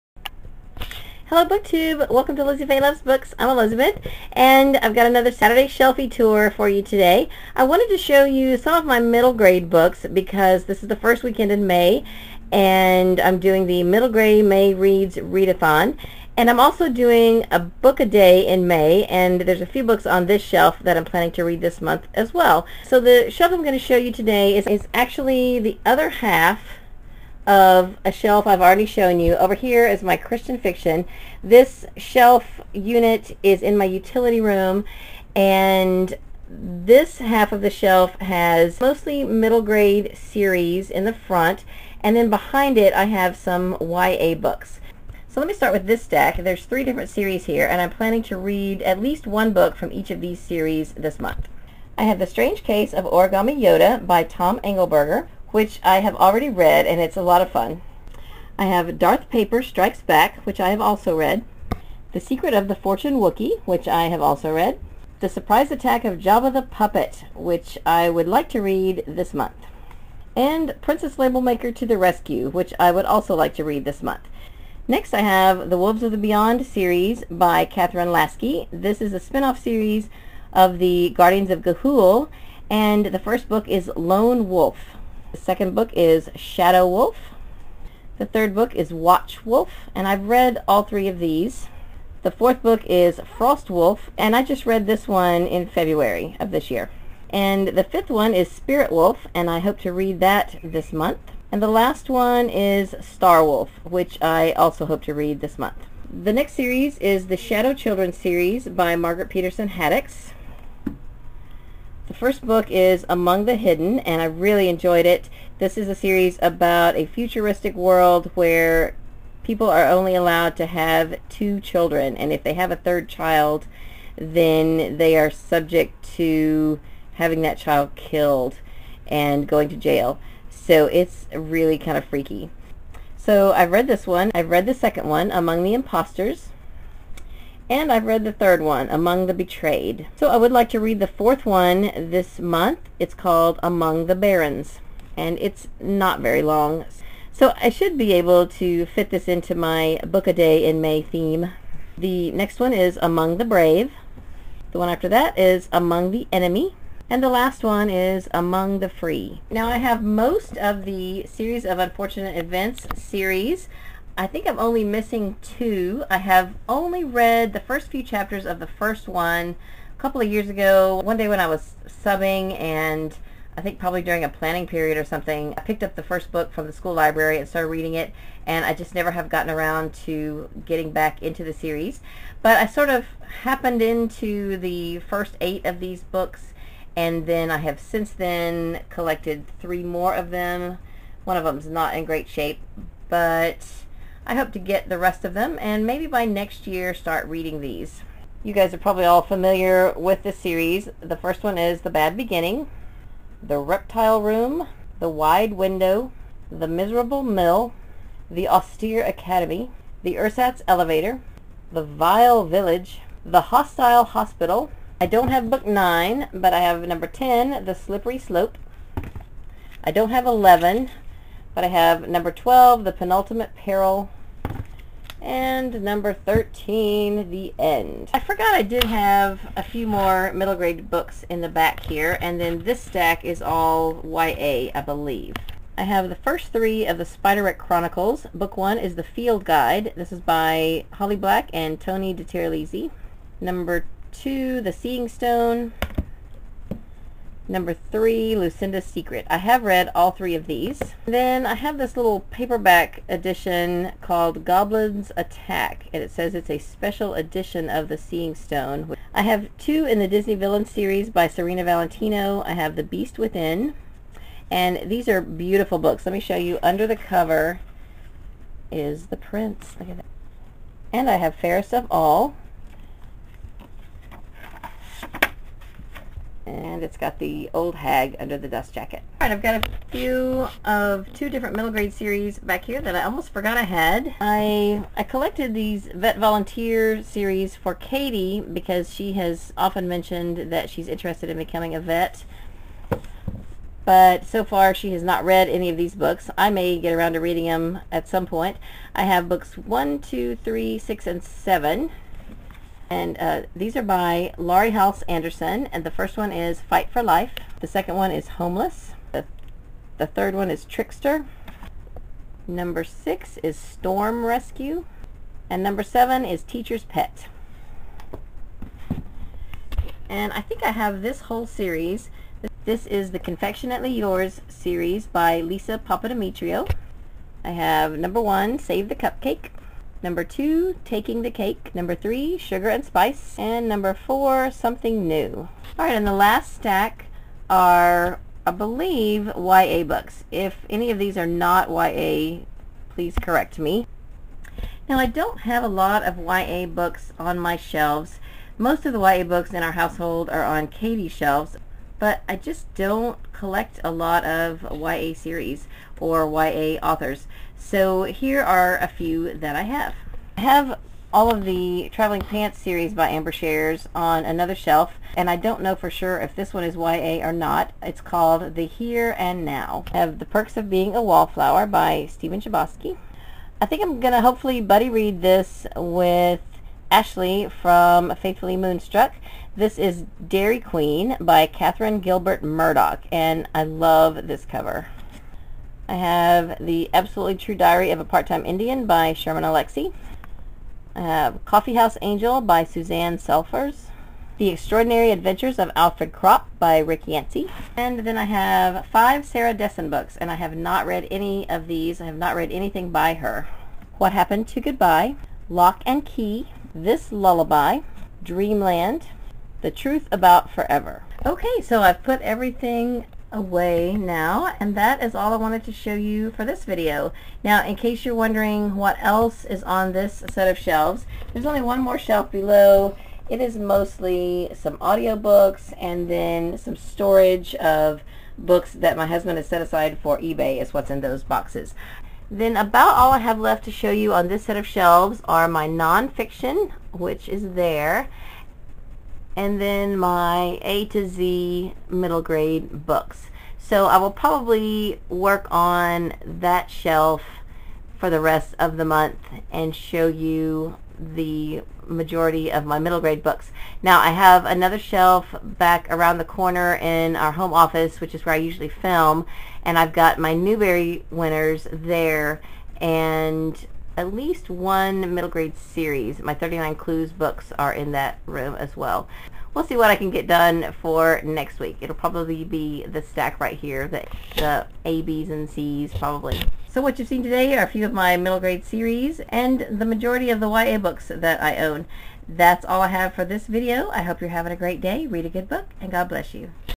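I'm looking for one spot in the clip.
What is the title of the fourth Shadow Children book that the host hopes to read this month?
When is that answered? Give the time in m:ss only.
2:23.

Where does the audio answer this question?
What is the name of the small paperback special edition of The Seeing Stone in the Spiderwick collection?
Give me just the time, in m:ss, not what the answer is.
4:14.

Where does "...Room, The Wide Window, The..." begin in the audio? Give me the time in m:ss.
3:24.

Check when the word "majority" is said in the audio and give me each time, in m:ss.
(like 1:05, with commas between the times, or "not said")
7:31, 7:59.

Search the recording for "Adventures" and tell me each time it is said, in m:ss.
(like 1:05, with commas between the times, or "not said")
6:35.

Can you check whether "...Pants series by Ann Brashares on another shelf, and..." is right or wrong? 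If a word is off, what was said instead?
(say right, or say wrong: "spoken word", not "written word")
right.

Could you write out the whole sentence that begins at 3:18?
You guys are probably all familiar with this series.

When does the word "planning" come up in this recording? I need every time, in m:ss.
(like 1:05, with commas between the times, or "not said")
0:21, 0:47, 2:54.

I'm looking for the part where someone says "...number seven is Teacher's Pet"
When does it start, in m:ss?
5:15.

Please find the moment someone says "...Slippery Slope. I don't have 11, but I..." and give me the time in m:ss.
3:37.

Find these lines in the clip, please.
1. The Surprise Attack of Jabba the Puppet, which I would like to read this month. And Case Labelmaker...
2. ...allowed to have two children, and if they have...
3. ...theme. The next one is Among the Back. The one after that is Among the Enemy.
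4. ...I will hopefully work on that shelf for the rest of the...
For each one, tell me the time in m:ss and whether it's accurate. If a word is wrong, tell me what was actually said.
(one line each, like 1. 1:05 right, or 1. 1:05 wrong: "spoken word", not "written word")
1. 1:05 wrong: "Princess", not "Case"
2. 2:00 right
3. 2:31 wrong: "Brave", not "Back"
4. 7:23 wrong: "probably", not "hopefully".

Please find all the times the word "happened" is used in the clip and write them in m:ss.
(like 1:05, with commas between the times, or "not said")
3:03, 6:44.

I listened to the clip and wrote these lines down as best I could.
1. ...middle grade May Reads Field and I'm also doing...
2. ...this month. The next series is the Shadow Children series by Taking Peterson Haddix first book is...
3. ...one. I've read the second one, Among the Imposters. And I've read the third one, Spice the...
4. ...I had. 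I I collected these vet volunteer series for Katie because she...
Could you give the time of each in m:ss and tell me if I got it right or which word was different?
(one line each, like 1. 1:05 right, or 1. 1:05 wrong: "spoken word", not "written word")
1. 0:13 wrong: "Readathon", not "Field"
2. 1:45 wrong: "Margaret", not "Taking"
3. 2:14 wrong: "Among", not "Spice"
4. 4:43 right.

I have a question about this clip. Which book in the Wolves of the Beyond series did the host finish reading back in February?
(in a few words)
Frost Wolf.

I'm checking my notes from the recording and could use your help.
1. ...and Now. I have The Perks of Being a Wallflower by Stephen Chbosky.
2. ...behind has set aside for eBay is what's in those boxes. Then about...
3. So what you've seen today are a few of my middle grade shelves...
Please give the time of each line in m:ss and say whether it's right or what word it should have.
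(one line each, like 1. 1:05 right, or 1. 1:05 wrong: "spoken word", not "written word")
1. 6:09 right
2. 7:09 wrong: "husband", not "behind"
3. 7:56 wrong: "series", not "shelves".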